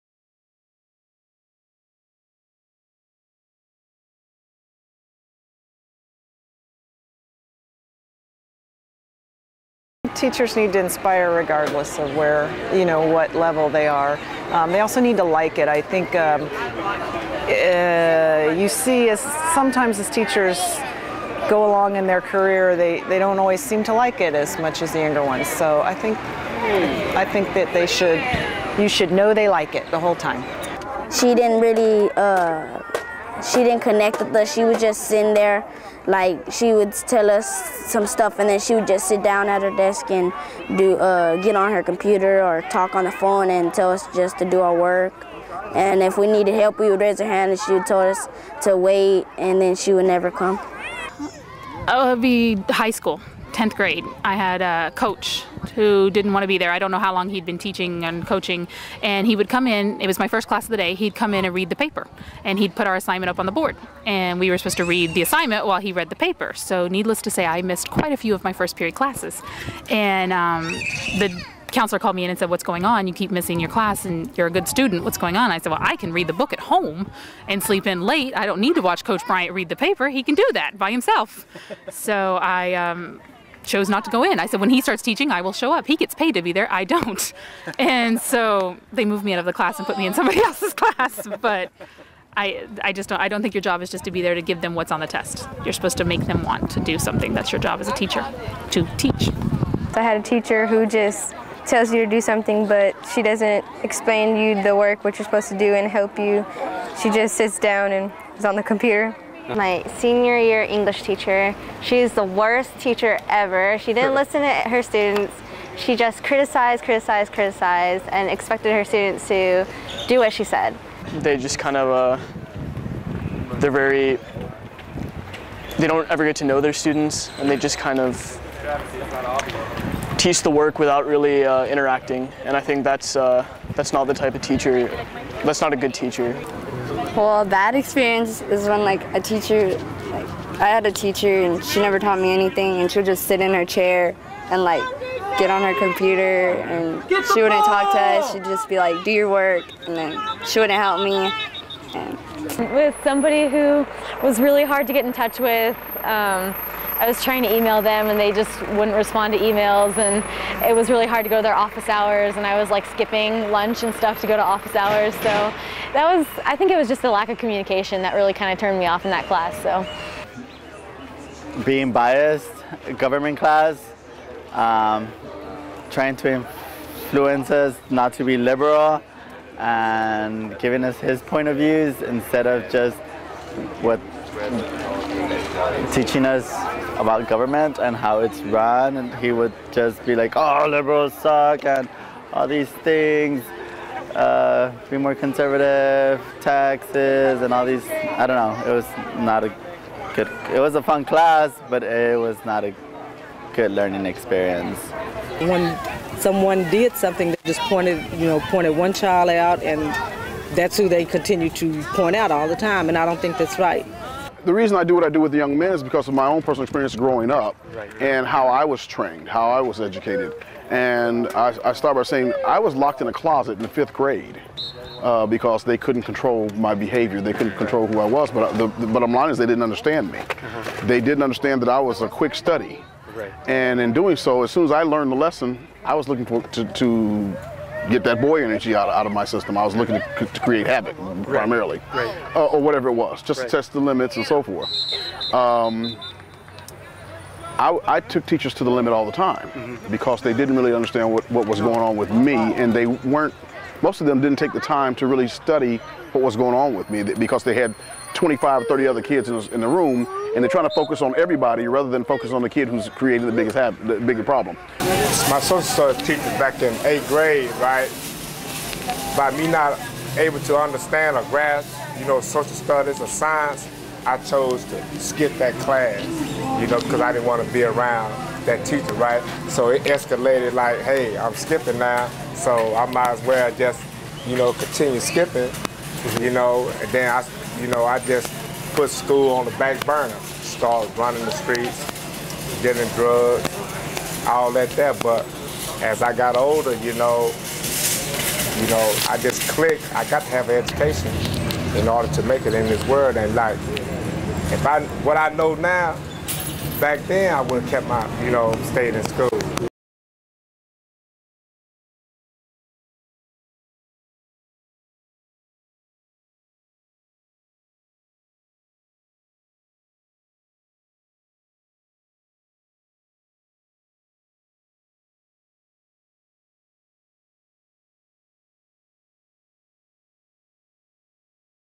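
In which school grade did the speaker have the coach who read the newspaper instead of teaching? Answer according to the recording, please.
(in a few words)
10th grade.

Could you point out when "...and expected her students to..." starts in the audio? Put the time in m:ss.
1:58.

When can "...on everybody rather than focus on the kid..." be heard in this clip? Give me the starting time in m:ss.
4:21.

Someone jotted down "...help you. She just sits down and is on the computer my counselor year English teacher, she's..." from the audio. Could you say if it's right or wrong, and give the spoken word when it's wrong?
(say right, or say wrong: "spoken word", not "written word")
wrong: "senior", not "counselor".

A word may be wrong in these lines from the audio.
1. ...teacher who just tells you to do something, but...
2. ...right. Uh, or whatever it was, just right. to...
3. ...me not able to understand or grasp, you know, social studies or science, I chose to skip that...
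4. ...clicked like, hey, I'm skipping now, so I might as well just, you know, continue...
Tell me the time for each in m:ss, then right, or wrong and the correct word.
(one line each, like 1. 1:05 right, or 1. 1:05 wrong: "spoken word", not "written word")
1. 1:40 right
2. 4:01 right
3. 4:29 right
4. 4:39 wrong: "escalated", not "clicked".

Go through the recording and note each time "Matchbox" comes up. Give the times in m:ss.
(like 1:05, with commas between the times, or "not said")
not said.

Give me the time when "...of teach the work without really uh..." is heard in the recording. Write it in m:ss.
2:07.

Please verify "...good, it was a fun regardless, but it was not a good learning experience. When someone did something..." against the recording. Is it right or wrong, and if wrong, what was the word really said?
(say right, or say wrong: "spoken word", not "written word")
wrong: "class", not "regardless".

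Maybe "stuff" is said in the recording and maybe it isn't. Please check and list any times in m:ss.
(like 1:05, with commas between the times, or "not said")
0:38, 2:43.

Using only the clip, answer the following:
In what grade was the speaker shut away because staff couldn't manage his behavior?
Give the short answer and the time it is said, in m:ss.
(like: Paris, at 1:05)
fifth grade, at 3:43.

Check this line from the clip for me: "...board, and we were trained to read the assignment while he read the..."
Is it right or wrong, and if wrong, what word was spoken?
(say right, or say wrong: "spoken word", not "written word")
wrong: "supposed", not "trained".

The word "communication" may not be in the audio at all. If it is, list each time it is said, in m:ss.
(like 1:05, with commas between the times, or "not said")
2:47.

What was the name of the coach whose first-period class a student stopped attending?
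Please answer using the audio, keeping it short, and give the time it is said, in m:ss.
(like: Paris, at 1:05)
Coach Bryant, at 1:19.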